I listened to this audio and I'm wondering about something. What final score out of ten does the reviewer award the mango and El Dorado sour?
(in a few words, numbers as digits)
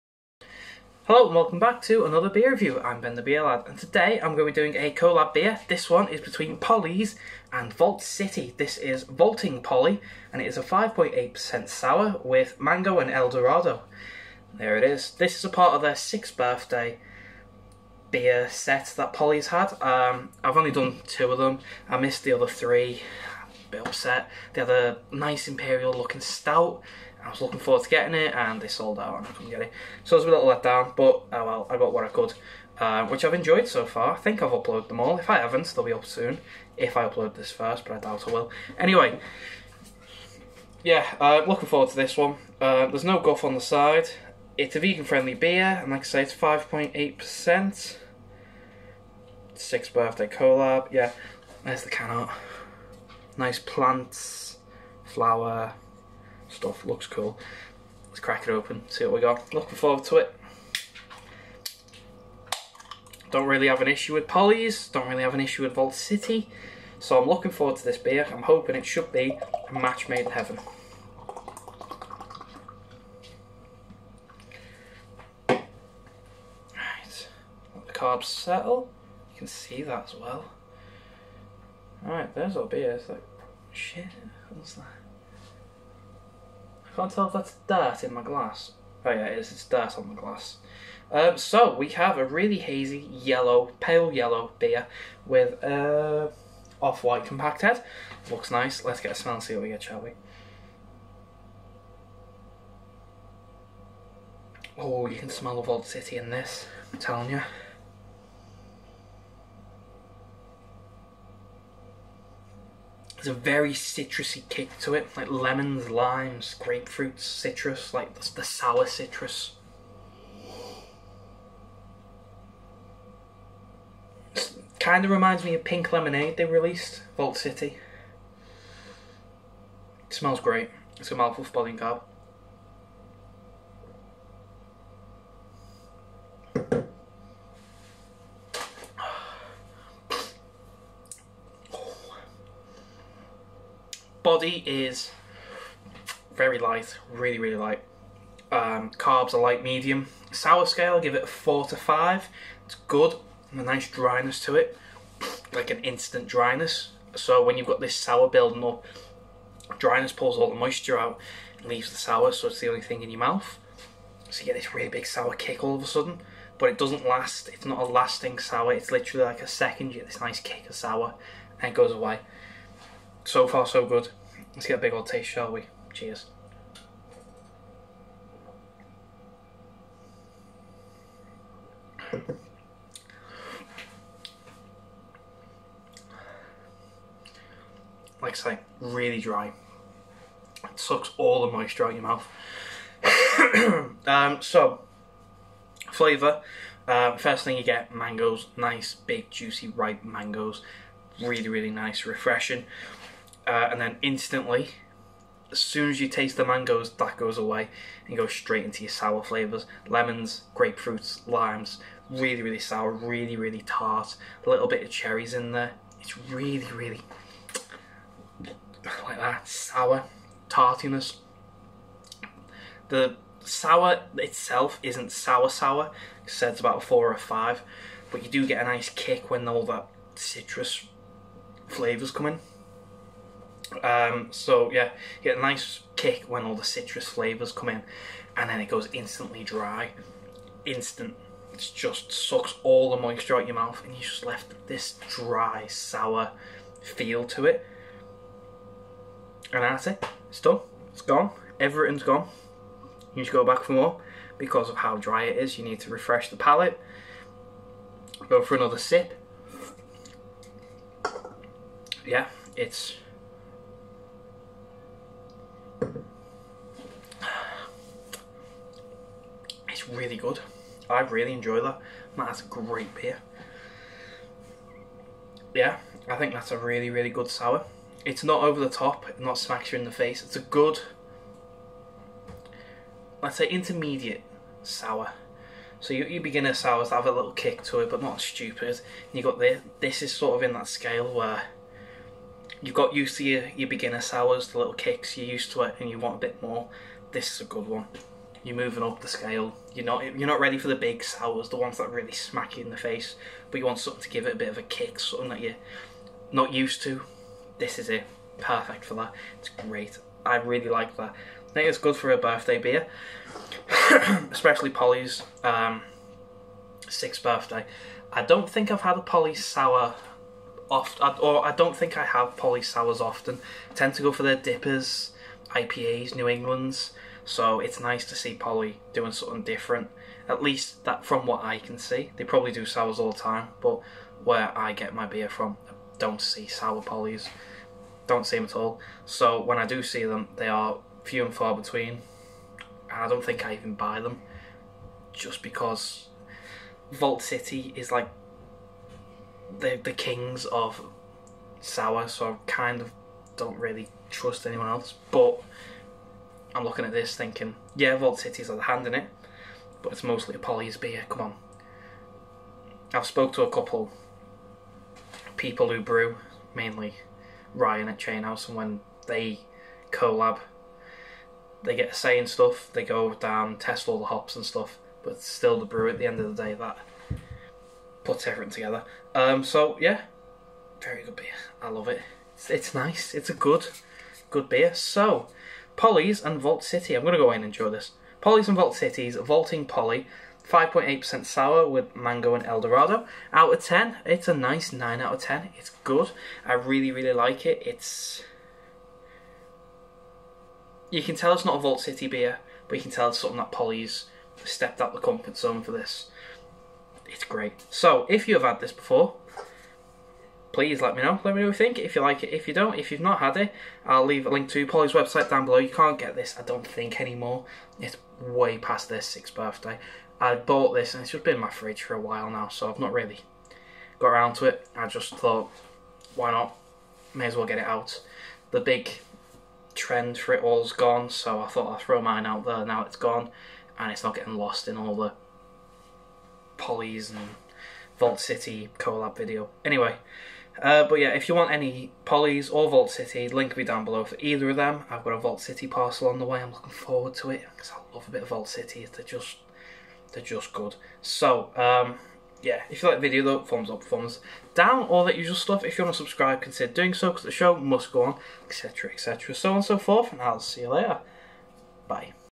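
9.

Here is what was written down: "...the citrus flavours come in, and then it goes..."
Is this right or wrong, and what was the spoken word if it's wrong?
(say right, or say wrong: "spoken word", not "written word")
right.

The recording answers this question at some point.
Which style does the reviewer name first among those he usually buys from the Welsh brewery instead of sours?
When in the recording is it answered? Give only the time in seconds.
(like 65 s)
324 s.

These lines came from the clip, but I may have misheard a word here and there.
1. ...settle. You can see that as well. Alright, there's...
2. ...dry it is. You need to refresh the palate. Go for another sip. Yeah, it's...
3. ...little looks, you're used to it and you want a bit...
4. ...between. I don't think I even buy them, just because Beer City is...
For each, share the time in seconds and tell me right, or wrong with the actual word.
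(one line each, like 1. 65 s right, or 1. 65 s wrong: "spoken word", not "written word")
1. 78 s right
2. 254 s right
3. 294 s wrong: "kicks", not "looks"
4. 341 s wrong: "Vault", not "Beer".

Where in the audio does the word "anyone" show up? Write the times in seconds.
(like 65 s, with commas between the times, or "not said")
354 s.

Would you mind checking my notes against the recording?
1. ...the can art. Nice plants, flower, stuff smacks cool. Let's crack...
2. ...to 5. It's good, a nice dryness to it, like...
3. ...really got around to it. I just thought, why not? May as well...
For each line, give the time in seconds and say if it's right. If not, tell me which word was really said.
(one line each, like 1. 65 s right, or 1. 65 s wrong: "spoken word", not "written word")
1. 51 s wrong: "looks", not "smacks"
2. 151 s right
3. 422 s right.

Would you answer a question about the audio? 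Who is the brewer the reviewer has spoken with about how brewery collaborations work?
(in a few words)
Ryan.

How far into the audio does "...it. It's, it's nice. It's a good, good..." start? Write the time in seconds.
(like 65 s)
381 s.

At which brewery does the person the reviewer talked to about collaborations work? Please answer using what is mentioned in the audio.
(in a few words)
Chainhouse.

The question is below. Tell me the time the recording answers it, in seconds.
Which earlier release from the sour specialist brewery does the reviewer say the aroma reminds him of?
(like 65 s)
125 s.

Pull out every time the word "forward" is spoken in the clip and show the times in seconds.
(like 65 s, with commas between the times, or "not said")
27 s, 41 s, 59 s, 67 s, 446 s.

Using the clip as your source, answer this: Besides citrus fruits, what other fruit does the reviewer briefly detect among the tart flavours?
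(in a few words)
Cherries.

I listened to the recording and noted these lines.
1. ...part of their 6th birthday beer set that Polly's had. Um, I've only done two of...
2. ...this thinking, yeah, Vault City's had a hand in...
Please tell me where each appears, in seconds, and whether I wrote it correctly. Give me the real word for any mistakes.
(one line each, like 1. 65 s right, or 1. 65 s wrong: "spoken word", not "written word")
1. 15 s right
2. 356 s right.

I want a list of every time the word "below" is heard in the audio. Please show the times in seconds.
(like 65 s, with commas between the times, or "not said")
415 s, 443 s.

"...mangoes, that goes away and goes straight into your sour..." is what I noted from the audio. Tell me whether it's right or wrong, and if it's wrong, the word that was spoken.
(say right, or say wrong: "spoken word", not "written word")
right.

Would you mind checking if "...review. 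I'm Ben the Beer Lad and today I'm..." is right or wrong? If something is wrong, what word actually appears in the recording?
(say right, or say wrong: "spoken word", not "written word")
right.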